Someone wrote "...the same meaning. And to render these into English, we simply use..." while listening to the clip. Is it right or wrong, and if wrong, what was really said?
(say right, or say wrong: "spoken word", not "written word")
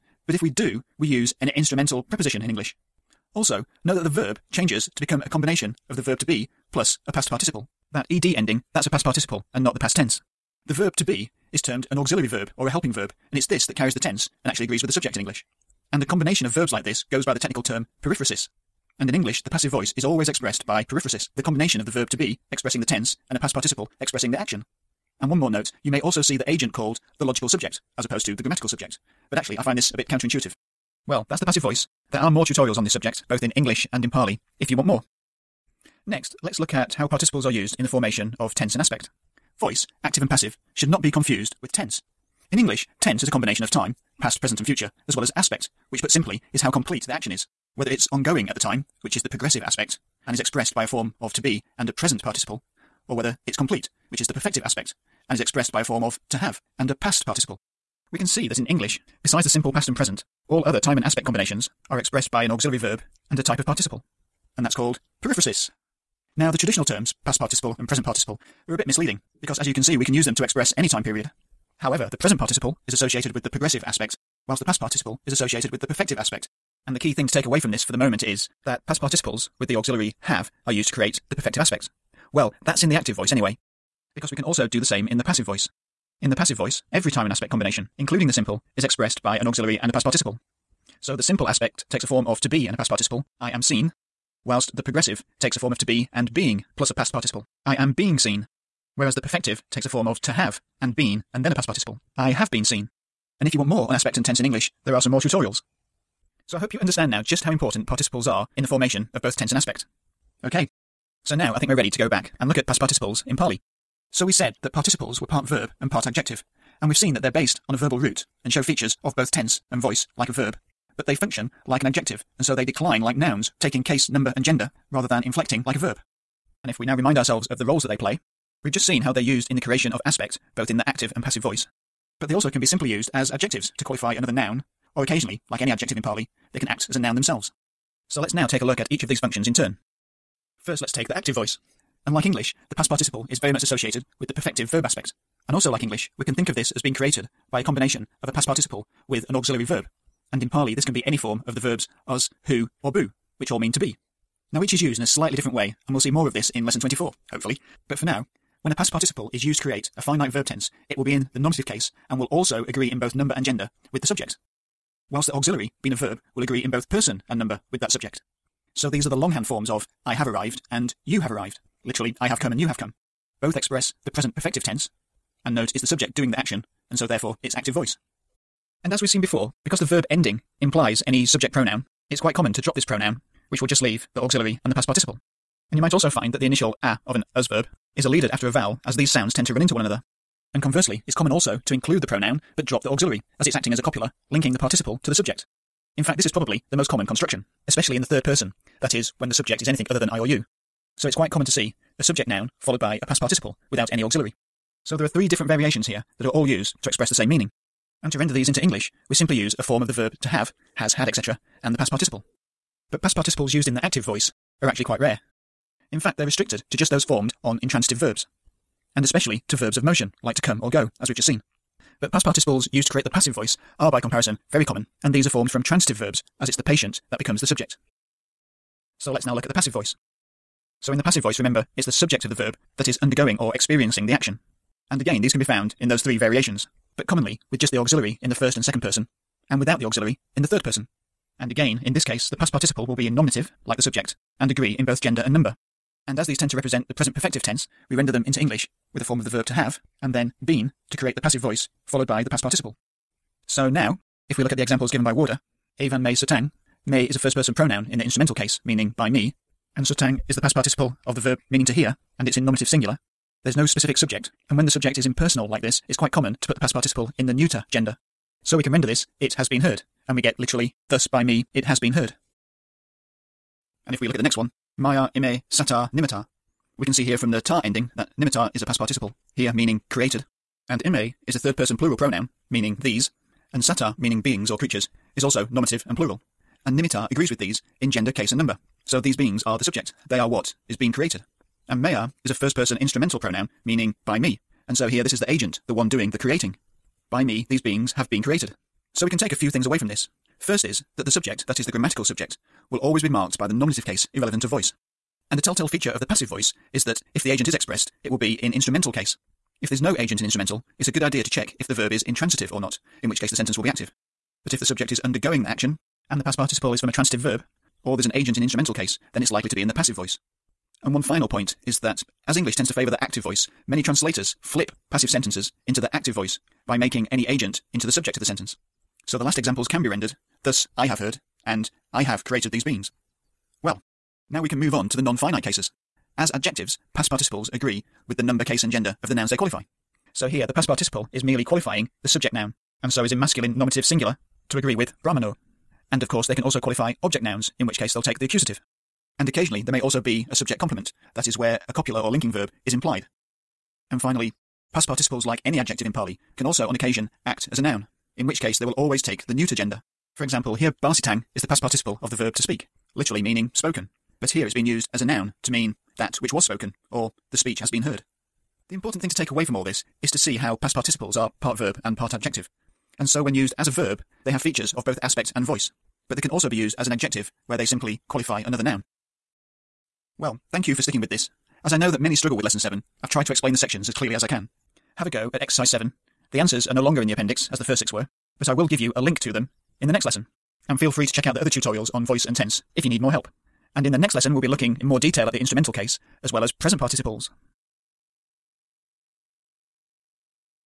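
right.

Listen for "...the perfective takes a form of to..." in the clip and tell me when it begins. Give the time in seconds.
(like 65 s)
99 s.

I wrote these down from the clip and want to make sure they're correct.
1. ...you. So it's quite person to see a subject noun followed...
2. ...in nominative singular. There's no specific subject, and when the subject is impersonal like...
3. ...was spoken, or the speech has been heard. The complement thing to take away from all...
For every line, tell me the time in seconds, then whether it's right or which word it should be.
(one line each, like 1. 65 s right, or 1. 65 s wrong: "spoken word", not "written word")
1. 200 s wrong: "common", not "person"
2. 262 s right
3. 366 s wrong: "important", not "complement".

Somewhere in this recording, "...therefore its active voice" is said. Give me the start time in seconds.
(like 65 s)
177 s.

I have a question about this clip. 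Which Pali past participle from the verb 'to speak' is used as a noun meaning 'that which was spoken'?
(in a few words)
barsitang.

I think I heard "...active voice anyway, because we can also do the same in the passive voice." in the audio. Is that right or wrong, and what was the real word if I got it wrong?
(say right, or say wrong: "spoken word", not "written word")
right.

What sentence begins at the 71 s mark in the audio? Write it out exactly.
However, the present participle is associated with the progressive aspect, whilst the past participle is associated with the perfective aspect.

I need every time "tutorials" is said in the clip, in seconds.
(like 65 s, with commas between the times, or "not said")
32 s, 105 s, 391 s.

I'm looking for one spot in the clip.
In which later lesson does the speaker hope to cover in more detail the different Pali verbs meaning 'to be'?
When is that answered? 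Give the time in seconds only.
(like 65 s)
156 s.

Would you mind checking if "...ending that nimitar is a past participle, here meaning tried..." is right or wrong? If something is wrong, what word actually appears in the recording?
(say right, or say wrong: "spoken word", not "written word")
wrong: "created", not "tried".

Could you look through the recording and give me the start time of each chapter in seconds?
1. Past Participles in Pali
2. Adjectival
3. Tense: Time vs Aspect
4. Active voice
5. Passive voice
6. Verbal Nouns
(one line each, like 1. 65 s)
1. 110 s
2. 334 s
3. 35 s
4. 139 s
5. 213 s
6. 354 s.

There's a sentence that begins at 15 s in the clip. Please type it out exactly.
And the combination of verbs like this goes by the technical term periphrasis.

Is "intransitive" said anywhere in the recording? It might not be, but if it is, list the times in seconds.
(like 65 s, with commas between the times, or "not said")
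217 s, 312 s.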